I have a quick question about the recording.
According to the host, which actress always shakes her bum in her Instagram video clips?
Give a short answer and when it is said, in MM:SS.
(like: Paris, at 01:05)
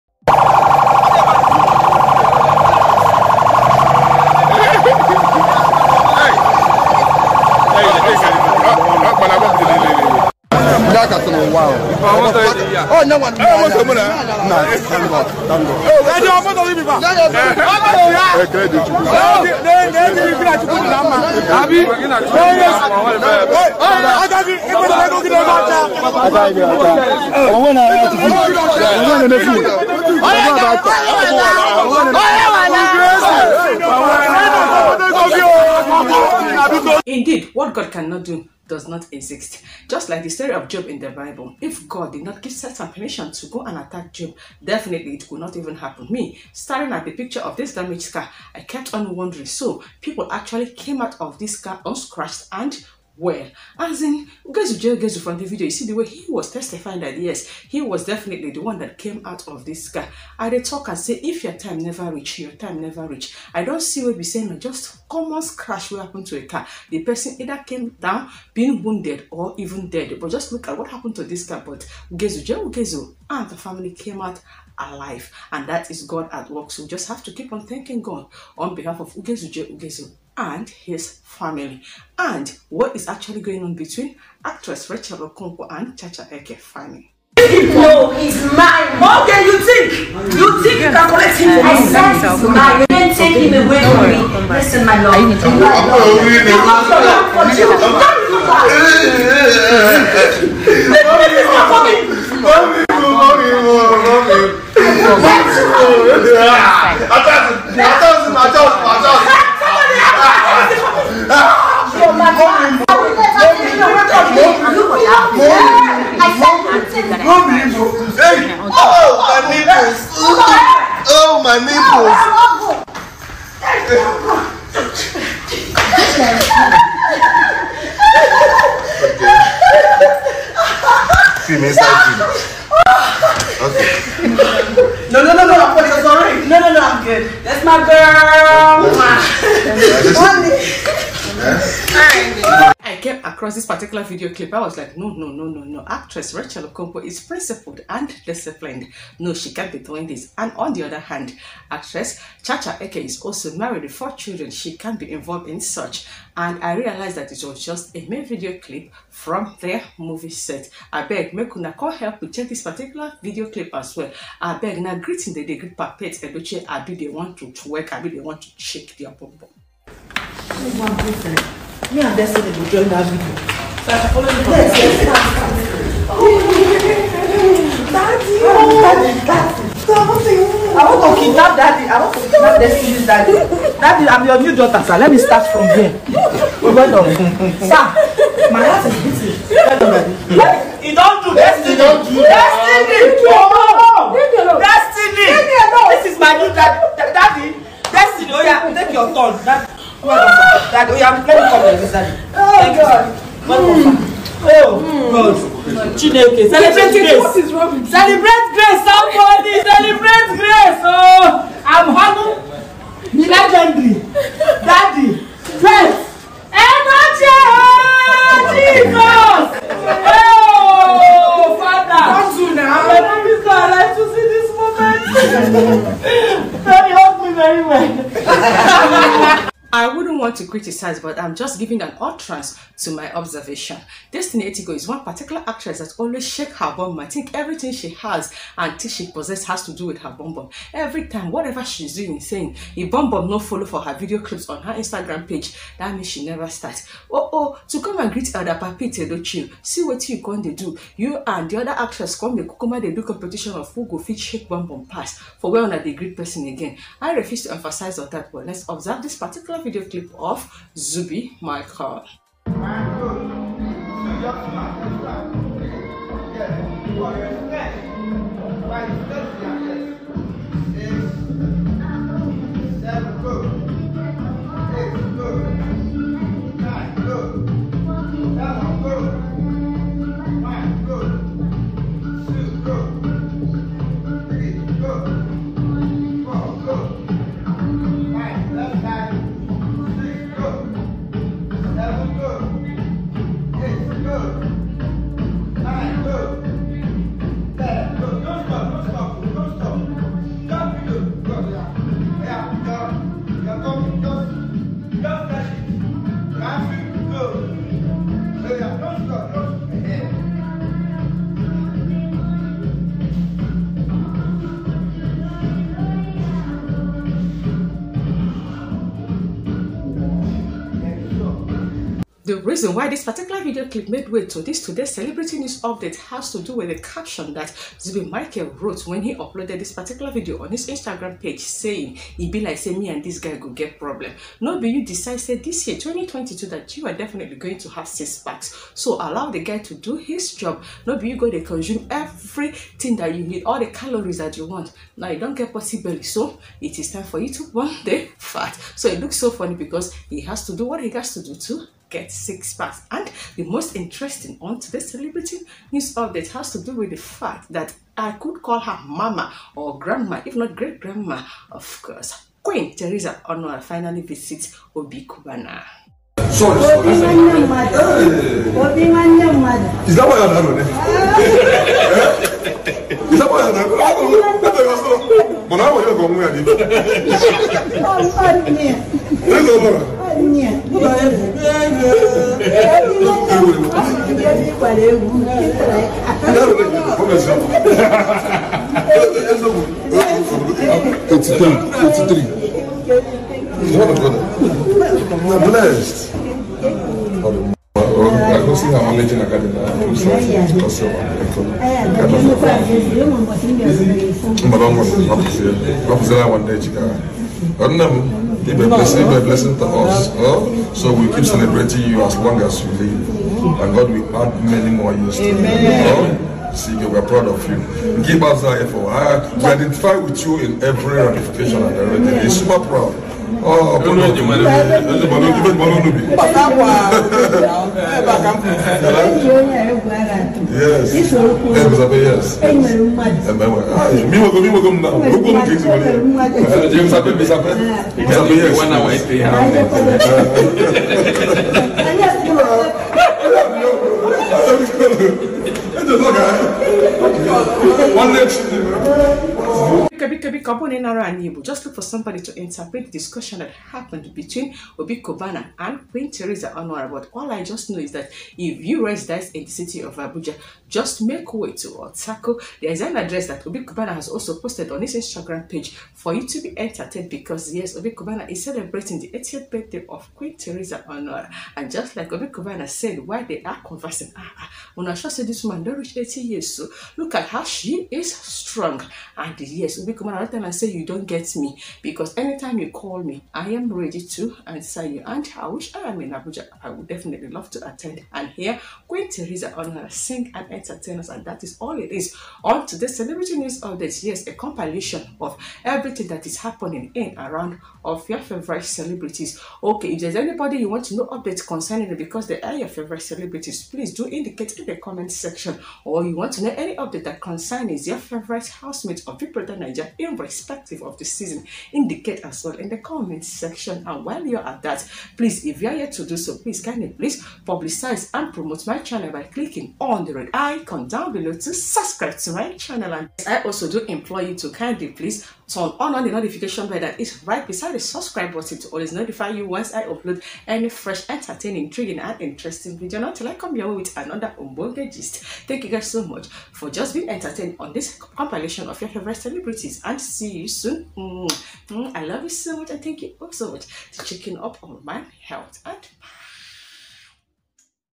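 Destiny Etigo, at 03:54.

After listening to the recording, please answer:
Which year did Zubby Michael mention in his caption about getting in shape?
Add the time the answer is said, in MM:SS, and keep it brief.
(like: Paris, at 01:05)
2022, at 05:35.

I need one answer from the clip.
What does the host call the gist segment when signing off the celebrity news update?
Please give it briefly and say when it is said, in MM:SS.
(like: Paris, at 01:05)
Umbonge gist, at 08:54.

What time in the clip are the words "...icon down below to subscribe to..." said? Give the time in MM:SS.
08:40.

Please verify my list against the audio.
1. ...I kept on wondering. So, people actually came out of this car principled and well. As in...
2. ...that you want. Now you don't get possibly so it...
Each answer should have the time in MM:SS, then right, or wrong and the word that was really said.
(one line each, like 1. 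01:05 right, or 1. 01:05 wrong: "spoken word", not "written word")
1. 00:48 wrong: "unscratched", not "principled"
2. 05:44 right.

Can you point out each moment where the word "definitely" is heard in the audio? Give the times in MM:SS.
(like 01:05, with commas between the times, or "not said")
00:44, 00:58, 05:36, 08:06.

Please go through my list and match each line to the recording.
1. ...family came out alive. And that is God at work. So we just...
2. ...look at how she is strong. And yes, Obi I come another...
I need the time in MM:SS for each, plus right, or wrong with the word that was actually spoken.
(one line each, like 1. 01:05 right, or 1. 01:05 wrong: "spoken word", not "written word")
1. 01:13 right
2. 07:56 right.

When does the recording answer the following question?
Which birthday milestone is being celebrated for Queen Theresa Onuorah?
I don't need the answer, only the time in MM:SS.
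07:49.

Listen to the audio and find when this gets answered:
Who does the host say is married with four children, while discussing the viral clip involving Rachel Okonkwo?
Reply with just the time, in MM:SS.
02:32.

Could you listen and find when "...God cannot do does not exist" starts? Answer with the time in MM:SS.
00:37.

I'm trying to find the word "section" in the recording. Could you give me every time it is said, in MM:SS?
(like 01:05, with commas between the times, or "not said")
08:25, 08:33.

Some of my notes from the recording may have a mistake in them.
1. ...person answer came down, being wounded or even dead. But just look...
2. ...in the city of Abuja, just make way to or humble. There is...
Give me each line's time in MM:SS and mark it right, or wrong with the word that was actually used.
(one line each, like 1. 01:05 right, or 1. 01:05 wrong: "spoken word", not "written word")
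1. 01:07 wrong: "either", not "answer"
2. 07:39 wrong: "tackle", not "humble".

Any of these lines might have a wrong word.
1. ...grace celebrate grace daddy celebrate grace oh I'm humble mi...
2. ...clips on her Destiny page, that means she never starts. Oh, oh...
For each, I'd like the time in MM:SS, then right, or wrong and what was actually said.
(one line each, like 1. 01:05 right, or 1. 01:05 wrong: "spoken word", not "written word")
1. 03:26 wrong: "somebody", not "daddy"
2. 04:04 wrong: "Instagram", not "Destiny".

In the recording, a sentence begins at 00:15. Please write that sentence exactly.
Oh, I don't want to leave people.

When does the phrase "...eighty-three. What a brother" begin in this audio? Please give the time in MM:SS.
06:31.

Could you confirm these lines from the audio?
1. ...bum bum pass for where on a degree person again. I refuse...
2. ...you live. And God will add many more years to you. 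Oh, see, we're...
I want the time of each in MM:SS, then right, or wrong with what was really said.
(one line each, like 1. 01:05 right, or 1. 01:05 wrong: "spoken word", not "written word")
1. 04:14 right
2. 06:52 right.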